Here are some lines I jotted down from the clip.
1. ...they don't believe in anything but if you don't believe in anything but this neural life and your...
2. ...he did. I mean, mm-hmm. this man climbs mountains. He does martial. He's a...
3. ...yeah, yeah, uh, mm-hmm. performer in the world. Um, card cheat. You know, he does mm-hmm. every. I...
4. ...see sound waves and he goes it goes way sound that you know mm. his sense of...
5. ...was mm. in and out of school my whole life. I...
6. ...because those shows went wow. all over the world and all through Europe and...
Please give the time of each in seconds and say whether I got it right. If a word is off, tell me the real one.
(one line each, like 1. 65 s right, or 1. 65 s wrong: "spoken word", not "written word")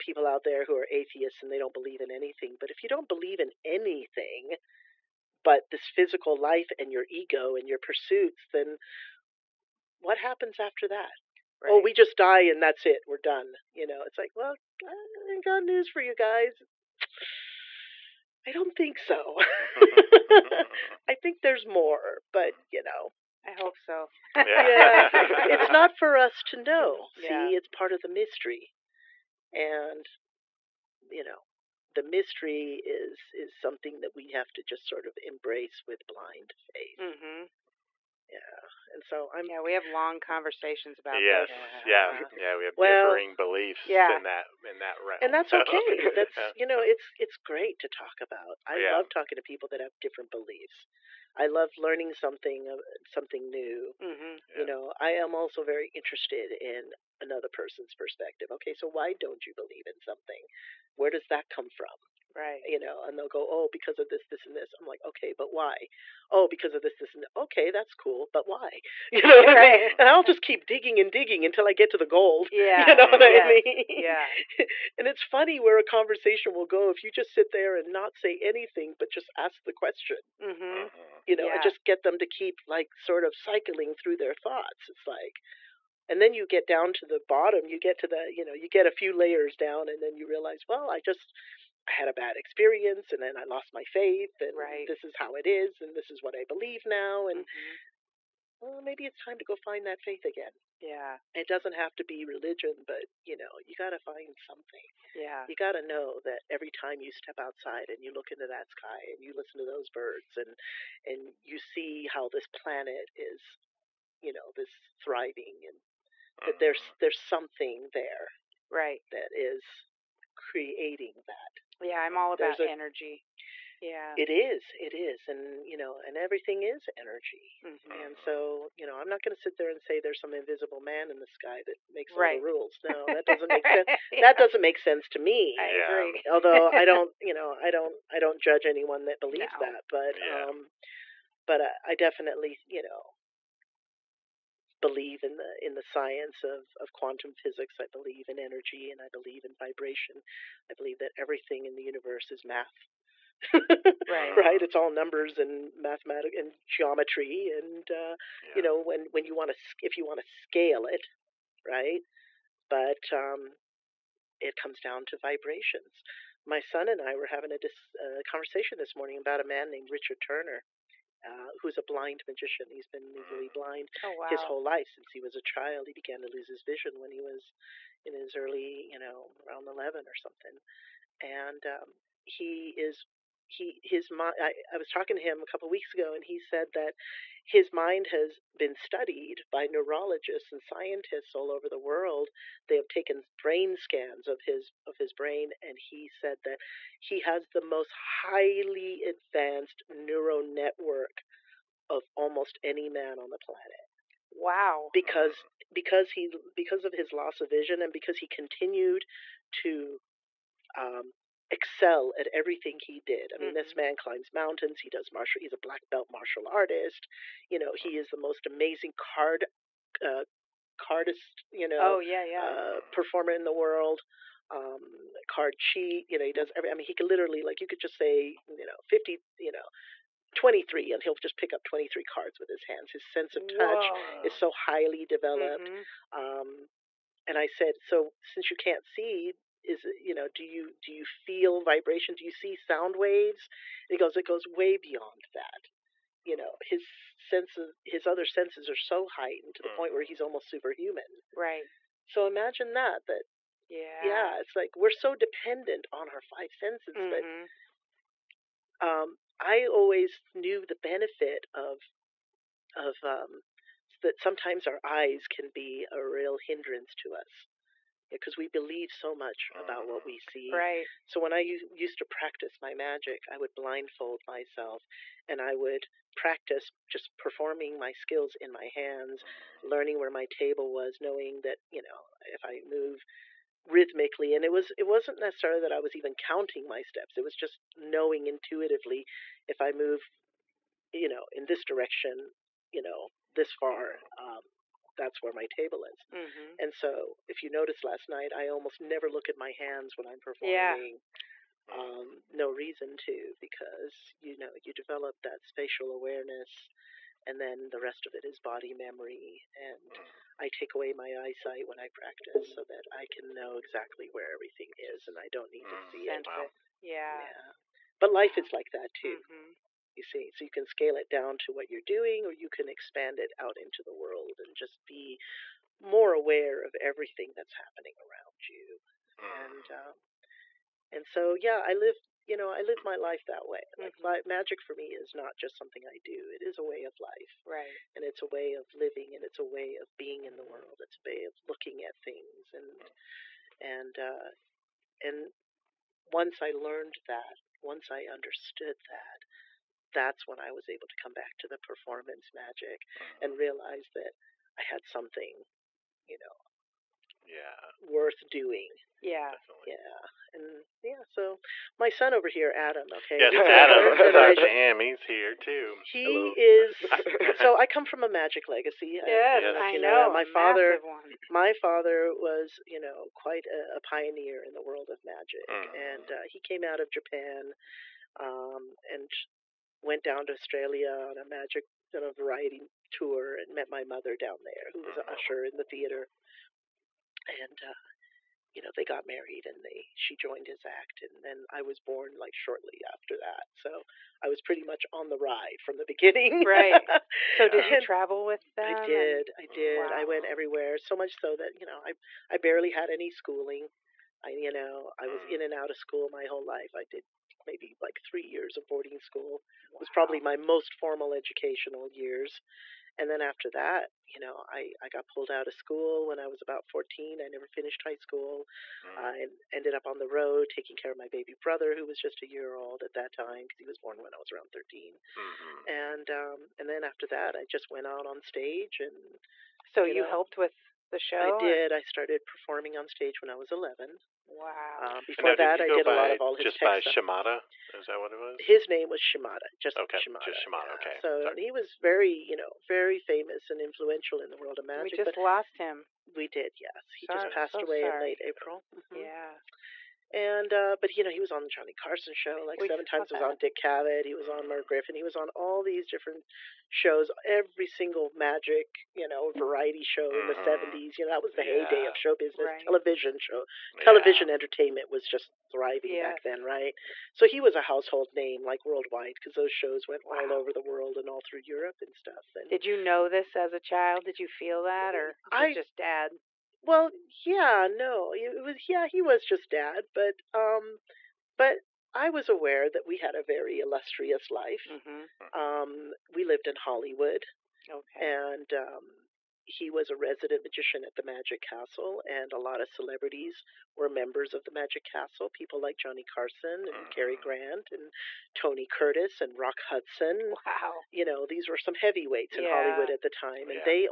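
1. 1 s wrong: "physical", not "neural"
2. 212 s right
3. 221 s right
4. 242 s wrong: "beyond", not "sound"
5. 405 s right
6. 469 s right.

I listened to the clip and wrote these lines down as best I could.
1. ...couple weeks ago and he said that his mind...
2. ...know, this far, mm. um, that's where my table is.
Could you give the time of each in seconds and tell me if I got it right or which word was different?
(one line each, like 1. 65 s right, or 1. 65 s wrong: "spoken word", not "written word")
1. 185 s right
2. 292 s right.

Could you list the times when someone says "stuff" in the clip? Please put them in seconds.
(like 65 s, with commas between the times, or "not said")
436 s, 471 s.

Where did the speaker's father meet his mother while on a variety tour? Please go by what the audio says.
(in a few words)
Australia.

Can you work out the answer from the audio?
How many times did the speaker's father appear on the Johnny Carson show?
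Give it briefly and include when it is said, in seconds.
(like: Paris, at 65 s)
7, at 452 s.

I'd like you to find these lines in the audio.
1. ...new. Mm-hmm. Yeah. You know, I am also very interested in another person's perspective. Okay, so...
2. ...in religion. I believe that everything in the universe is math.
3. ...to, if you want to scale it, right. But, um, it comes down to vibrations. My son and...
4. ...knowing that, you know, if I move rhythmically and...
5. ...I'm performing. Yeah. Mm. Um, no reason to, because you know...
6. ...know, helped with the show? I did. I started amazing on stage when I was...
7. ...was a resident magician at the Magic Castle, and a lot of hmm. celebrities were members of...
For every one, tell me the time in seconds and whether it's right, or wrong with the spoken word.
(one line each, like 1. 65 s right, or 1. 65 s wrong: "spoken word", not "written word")
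1. 53 s right
2. 149 s wrong: "vibration", not "religion"
3. 159 s right
4. 280 s right
5. 300 s right
6. 430 s wrong: "performing", not "amazing"
7. 489 s right.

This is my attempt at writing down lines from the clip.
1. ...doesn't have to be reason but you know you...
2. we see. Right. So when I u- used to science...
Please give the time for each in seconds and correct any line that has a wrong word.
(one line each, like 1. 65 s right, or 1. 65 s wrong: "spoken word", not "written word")
1. 101 s wrong: "religion", not "reason"
2. 270 s wrong: "practice", not "science".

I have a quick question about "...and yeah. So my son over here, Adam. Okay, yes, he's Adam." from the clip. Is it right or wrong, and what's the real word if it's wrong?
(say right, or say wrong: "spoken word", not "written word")
right.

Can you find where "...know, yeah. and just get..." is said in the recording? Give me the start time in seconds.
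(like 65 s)
81 s.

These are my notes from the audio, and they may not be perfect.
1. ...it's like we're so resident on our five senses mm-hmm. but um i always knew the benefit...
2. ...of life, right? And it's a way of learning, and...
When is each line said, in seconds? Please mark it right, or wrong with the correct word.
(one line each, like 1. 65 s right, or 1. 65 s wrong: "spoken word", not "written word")
1. 254 s wrong: "dependent", not "resident"
2. 336 s wrong: "living", not "learning".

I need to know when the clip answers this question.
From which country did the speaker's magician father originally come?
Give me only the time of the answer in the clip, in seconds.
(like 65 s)
376 s.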